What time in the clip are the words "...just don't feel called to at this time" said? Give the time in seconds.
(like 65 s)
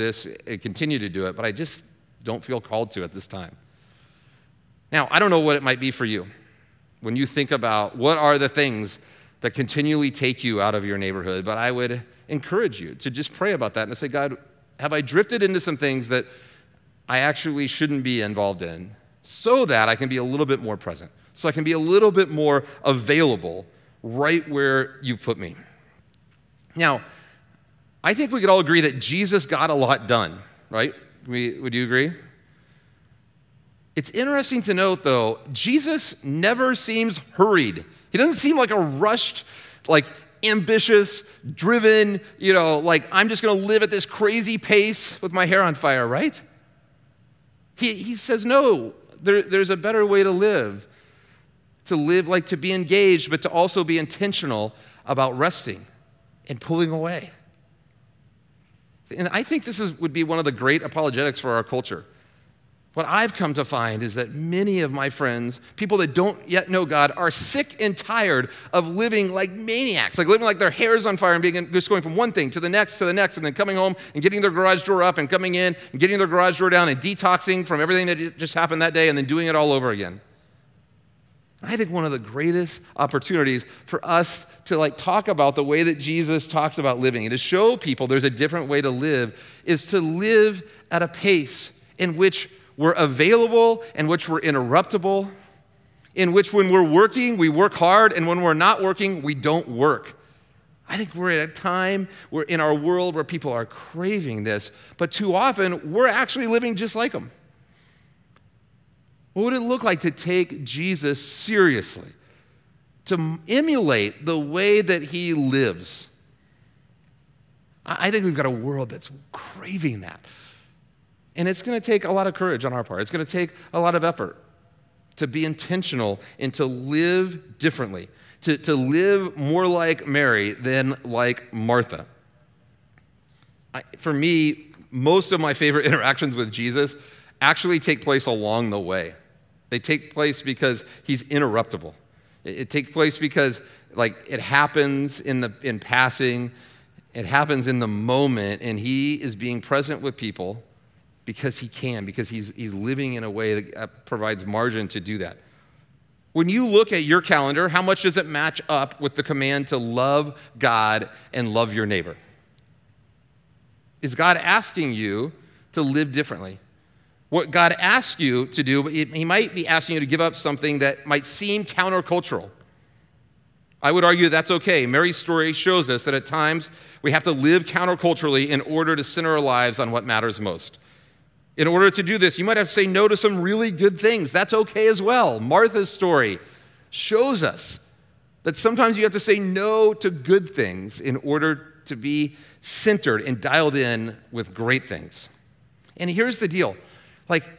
1 s.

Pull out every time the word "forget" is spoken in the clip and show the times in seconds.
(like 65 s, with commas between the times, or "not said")
not said.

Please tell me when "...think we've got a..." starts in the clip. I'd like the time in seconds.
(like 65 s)
118 s.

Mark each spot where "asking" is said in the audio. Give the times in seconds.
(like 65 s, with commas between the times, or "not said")
164 s, 169 s.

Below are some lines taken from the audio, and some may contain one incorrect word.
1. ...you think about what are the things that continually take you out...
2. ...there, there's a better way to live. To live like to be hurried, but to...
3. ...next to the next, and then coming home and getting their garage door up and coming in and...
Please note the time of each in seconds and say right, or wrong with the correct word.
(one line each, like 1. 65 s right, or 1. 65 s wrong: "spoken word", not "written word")
1. 7 s right
2. 49 s wrong: "engaged", not "hurried"
3. 72 s right.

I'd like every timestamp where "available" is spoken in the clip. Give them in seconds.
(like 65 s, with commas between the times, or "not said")
22 s, 92 s.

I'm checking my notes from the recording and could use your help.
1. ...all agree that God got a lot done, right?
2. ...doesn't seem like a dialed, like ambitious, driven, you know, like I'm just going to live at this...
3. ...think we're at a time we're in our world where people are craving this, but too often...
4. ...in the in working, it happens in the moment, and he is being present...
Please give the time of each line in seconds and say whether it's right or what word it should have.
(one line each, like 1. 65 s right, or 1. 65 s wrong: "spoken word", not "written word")
1. 28 s wrong: "Jesus", not "God"
2. 38 s wrong: "rushed", not "dialed"
3. 100 s right
4. 145 s wrong: "passing", not "working".